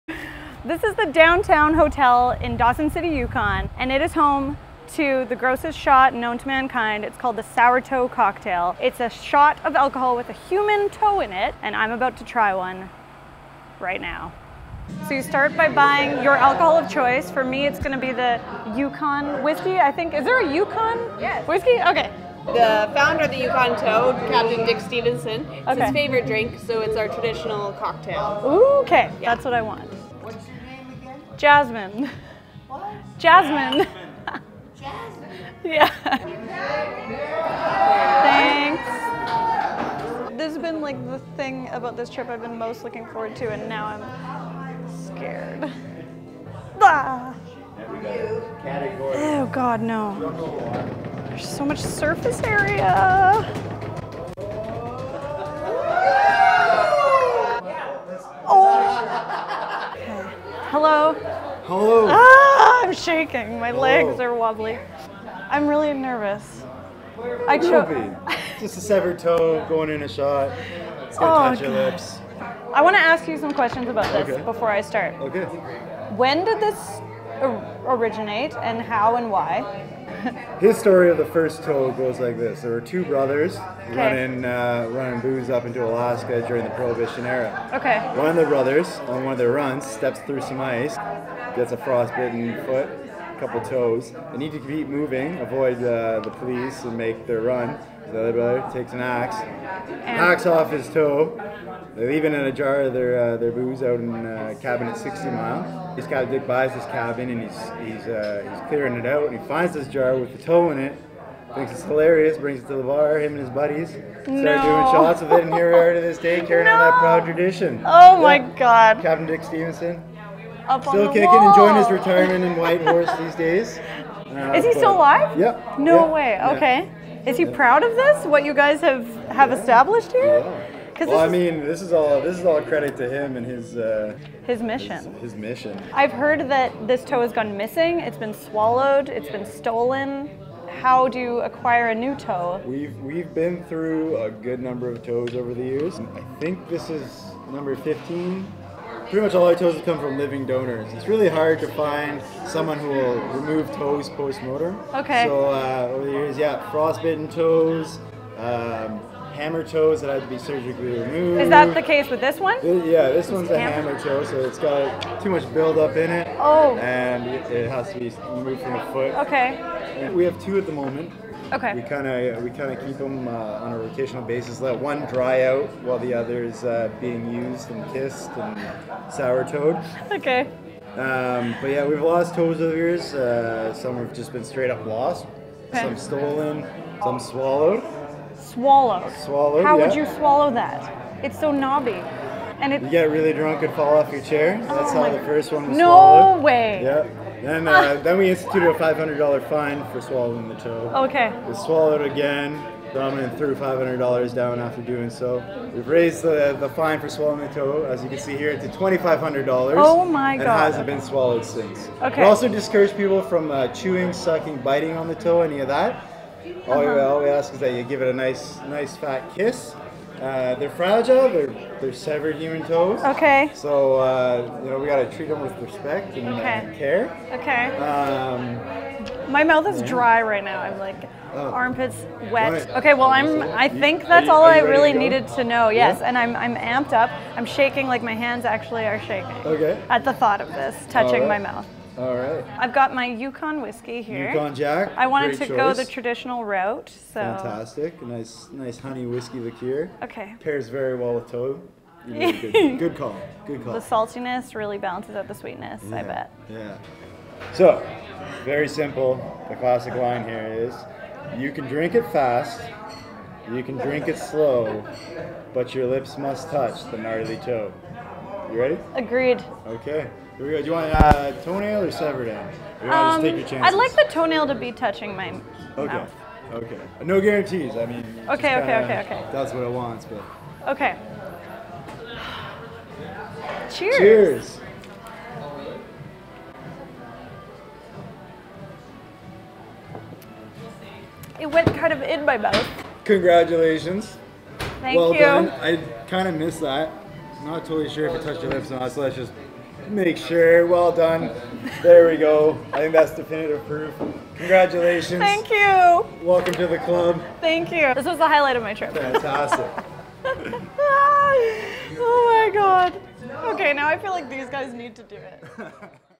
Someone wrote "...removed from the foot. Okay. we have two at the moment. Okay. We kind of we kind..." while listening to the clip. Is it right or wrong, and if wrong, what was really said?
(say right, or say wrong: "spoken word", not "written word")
right.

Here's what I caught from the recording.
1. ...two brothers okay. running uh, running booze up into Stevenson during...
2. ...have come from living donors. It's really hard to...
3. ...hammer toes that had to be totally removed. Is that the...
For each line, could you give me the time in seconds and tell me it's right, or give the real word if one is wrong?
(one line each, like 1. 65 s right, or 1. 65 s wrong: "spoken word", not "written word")
1. 82 s wrong: "Alaska", not "Stevenson"
2. 149 s right
3. 159 s wrong: "surgically", not "totally".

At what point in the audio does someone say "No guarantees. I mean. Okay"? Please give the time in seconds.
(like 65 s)
277 s.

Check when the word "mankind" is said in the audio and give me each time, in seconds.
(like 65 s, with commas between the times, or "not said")
6 s.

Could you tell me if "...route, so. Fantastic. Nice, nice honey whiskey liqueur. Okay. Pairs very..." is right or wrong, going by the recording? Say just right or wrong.
right.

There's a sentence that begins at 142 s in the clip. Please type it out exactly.
We've we've been through a good number of toes over the years.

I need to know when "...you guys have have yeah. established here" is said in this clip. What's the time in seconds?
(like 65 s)
128 s.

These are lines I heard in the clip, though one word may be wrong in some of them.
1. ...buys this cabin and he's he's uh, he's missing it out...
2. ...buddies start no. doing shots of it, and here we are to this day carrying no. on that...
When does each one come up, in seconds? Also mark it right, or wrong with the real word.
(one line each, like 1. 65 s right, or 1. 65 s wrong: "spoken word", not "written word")
1. 106 s wrong: "clearing", not "missing"
2. 113 s right.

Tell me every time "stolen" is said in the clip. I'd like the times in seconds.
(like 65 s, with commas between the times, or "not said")
139 s, 185 s.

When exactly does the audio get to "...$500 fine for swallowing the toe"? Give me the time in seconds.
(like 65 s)
198 s.